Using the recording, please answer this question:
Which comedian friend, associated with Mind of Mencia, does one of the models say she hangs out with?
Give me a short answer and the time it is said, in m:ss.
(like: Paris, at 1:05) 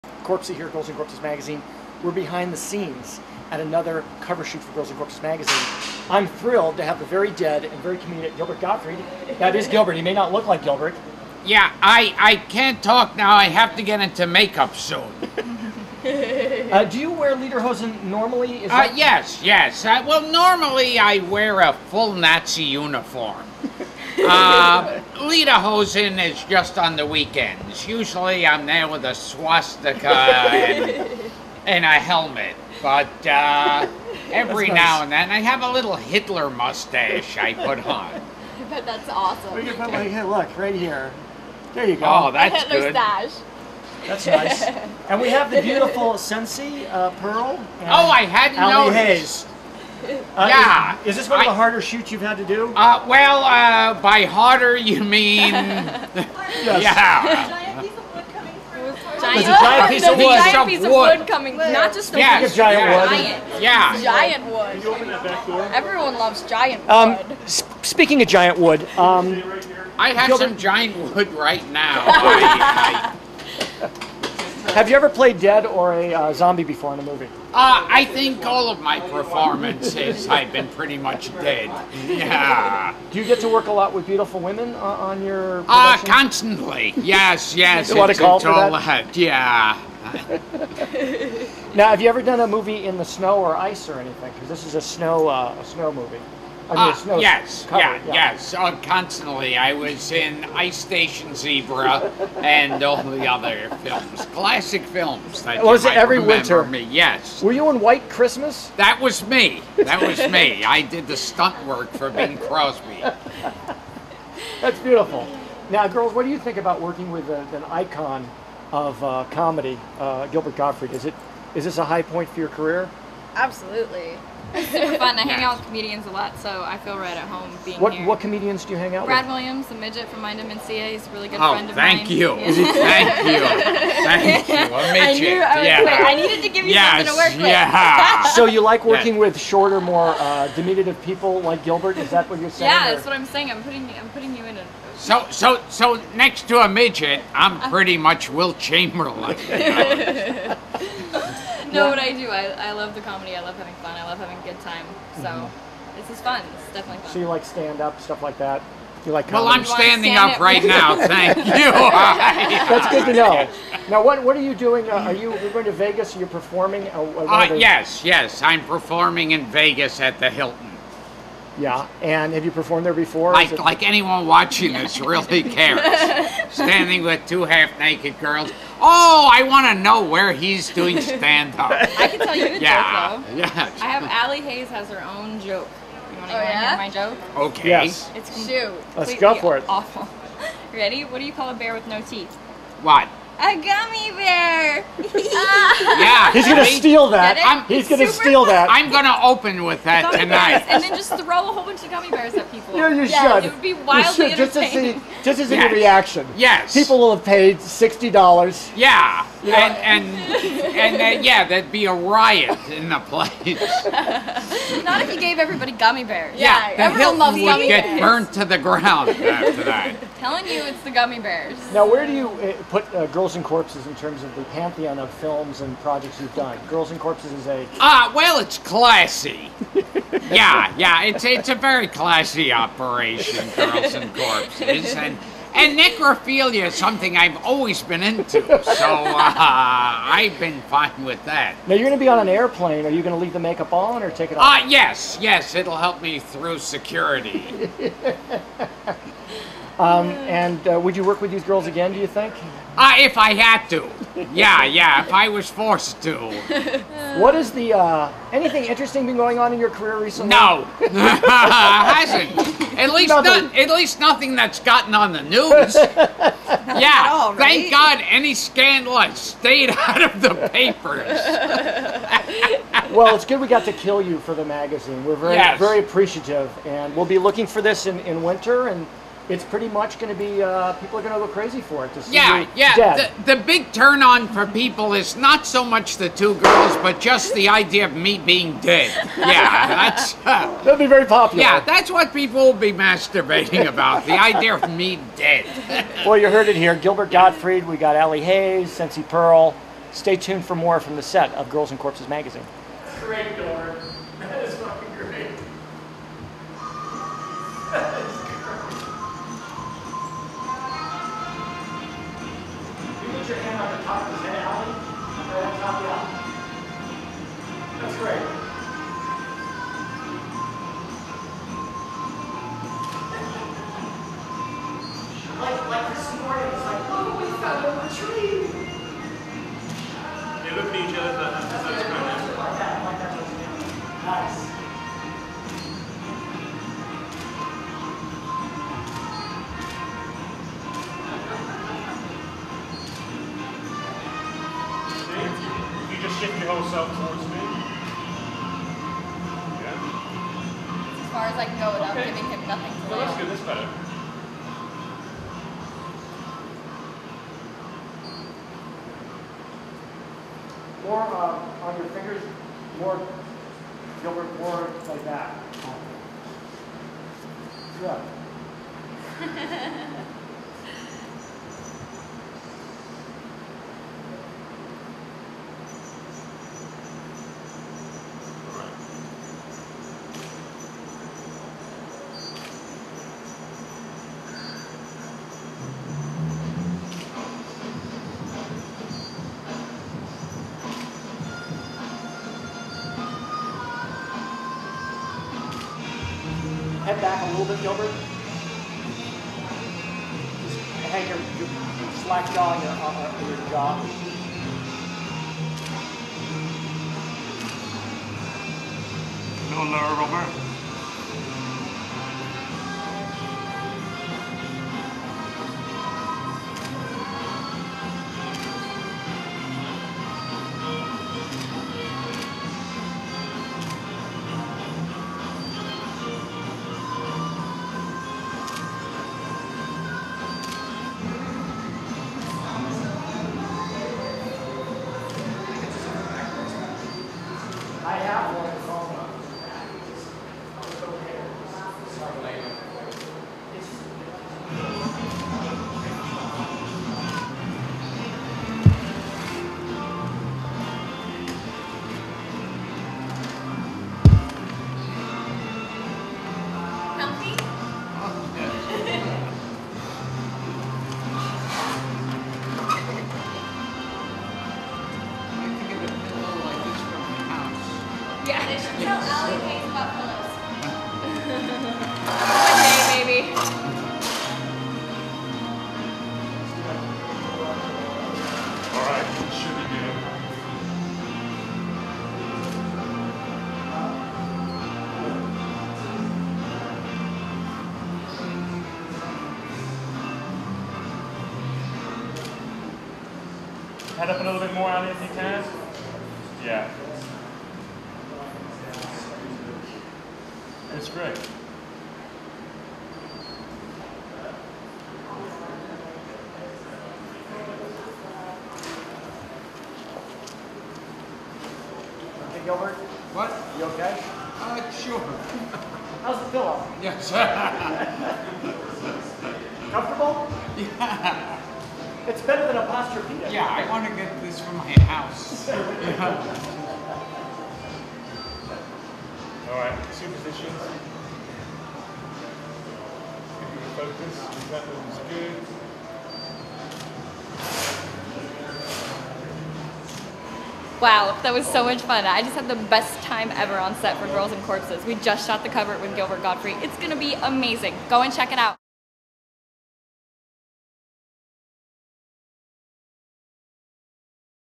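Brad Williams, at 2:09.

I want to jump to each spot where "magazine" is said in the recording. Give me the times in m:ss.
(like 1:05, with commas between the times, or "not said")
0:01, 0:05, 4:34, 5:02.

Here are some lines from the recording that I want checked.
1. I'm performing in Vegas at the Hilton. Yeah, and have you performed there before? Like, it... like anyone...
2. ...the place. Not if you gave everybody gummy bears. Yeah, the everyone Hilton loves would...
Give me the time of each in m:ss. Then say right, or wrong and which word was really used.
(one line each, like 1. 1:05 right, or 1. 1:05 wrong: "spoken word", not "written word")
1. 2:48 right
2. 3:32 right.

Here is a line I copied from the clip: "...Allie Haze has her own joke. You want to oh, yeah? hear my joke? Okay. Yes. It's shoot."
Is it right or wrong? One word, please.
right.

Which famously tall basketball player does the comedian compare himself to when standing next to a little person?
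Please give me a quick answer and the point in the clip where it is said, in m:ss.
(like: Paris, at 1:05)
Wilt Chamberlain, at 2:28.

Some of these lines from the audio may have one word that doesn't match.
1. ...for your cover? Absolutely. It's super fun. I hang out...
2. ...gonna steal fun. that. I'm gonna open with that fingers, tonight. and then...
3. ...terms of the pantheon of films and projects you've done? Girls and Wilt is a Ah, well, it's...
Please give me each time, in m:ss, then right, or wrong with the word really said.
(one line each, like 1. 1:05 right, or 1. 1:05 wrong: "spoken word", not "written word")
1. 2:02 wrong: "career", not "cover"
2. 3:17 wrong: "bears", not "fingers"
3. 3:43 wrong: "Corpses", not "Wilt".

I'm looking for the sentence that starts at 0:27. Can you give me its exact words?
Usually I'm there with a swastika and, and a helmet.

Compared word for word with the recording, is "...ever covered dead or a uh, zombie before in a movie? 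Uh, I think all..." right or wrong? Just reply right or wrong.
wrong.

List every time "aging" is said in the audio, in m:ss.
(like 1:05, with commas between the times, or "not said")
not said.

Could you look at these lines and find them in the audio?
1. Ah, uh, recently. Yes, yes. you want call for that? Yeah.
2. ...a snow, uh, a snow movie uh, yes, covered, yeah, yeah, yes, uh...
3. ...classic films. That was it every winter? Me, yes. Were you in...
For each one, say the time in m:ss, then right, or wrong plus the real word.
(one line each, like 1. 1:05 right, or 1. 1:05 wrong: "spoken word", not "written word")
1. 1:25 wrong: "constantly", not "recently"
2. 1:34 right
3. 1:44 right.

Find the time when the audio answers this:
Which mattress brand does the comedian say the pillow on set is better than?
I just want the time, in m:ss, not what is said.
8:42.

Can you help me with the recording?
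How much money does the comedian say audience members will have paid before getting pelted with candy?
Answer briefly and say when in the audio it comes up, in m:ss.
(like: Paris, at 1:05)
60 dollars, at 3:27.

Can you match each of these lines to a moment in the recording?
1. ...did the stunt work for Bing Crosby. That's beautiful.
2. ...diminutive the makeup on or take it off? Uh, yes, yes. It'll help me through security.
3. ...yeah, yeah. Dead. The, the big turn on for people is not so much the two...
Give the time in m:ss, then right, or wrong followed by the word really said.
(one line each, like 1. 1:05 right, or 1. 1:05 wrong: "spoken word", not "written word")
1. 1:50 right
2. 4:03 wrong: "leave", not "diminutive"
3. 4:42 right.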